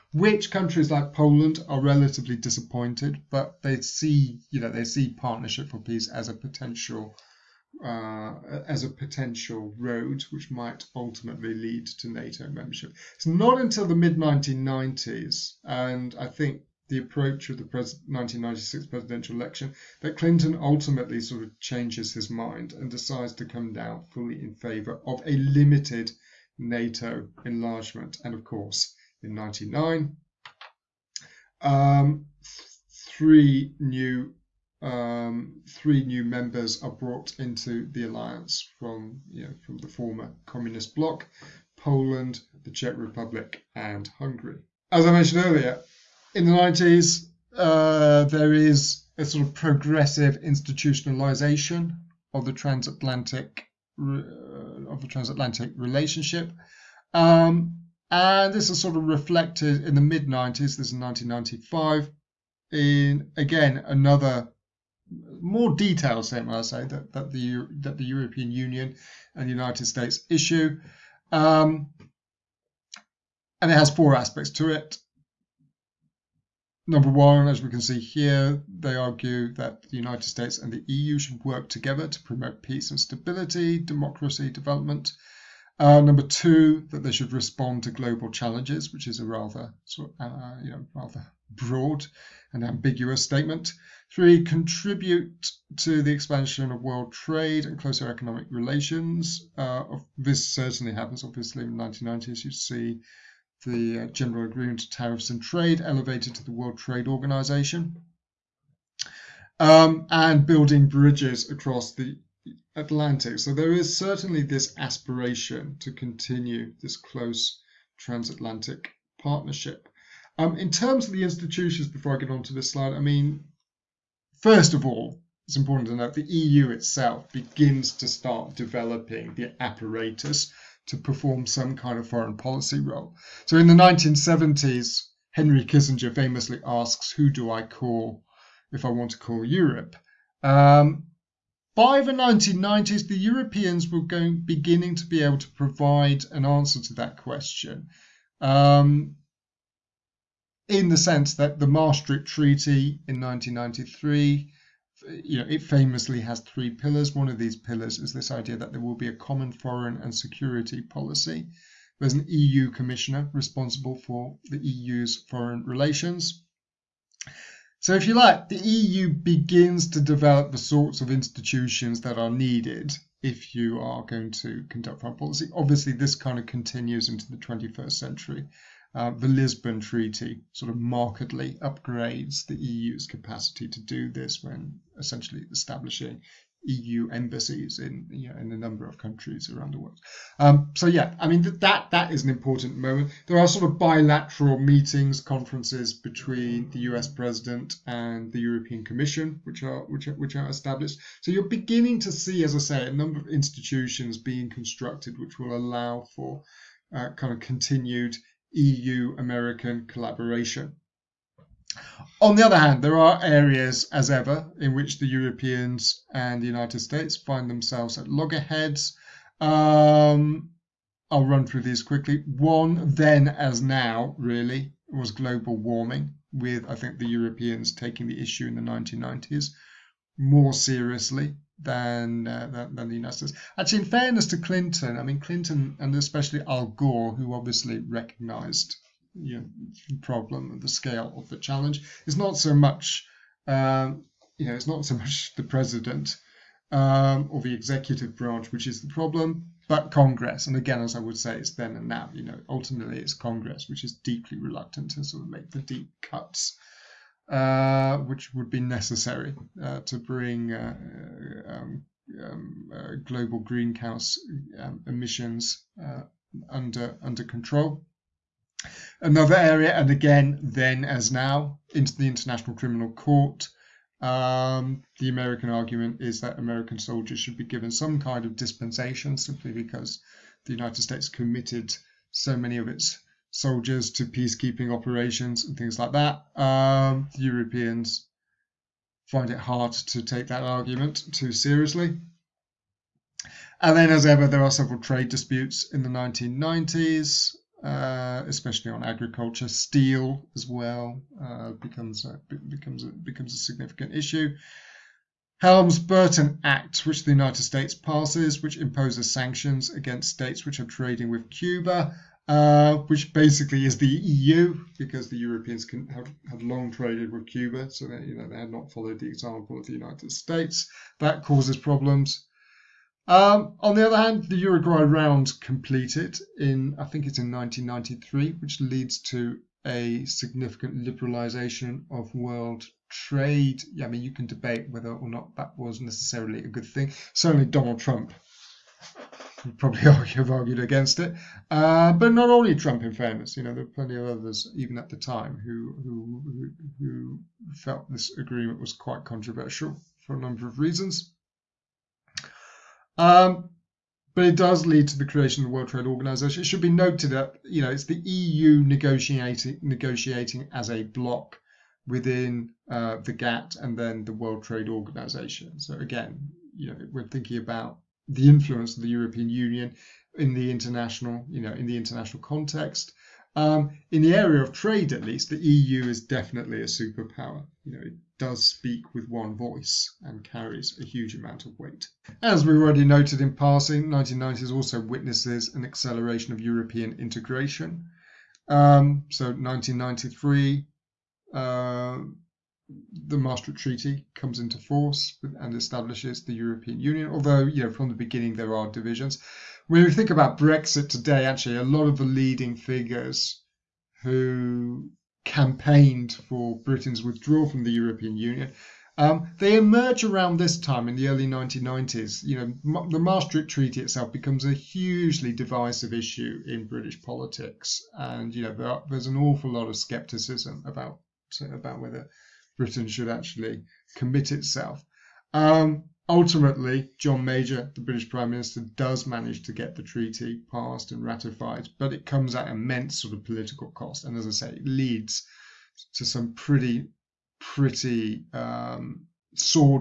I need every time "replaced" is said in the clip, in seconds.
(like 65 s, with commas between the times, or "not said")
not said.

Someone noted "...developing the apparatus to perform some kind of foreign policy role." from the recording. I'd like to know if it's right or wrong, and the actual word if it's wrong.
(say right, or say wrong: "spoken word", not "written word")
right.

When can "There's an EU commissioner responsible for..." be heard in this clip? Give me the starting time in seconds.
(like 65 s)
161 s.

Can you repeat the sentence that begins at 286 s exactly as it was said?
Um, the Europeans find it hard to take that argument too seriously.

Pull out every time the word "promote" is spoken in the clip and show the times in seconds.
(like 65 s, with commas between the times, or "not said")
82 s.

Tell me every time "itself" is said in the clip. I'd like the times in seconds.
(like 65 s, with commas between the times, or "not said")
126 s, 413 s, 424 s.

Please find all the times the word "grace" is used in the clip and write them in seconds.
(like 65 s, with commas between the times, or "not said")
not said.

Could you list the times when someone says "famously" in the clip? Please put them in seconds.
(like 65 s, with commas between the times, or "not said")
136 s, 155 s.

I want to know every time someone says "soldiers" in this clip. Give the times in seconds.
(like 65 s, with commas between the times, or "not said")
276 s, 283 s.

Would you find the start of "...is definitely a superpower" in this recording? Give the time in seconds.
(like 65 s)
375 s.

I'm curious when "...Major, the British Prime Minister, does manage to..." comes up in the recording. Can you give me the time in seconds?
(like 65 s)
427 s.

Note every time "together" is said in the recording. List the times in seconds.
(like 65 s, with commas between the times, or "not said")
81 s.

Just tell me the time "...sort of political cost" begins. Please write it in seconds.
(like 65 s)
433 s.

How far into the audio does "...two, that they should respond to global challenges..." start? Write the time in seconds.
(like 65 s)
86 s.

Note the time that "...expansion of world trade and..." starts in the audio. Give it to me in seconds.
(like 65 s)
96 s.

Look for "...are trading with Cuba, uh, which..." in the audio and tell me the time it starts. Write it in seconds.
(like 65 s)
310 s.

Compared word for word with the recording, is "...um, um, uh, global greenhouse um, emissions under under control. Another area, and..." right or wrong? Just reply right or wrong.
right.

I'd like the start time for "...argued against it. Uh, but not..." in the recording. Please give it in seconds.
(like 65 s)
340 s.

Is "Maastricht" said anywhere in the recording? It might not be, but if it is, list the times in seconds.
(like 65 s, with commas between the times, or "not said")
151 s, 393 s, 412 s.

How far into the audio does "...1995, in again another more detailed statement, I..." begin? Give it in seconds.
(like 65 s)
60 s.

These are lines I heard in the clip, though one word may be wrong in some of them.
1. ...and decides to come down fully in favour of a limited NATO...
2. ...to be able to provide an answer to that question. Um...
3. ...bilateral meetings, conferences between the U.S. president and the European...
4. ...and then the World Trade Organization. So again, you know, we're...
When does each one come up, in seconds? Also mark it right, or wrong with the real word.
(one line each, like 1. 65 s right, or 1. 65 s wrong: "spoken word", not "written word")
1. 22 s right
2. 144 s right
3. 193 s right
4. 363 s right.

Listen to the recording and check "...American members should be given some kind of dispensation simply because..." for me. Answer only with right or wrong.
wrong.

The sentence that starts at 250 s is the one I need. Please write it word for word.
And again, as I would say, it's then and now.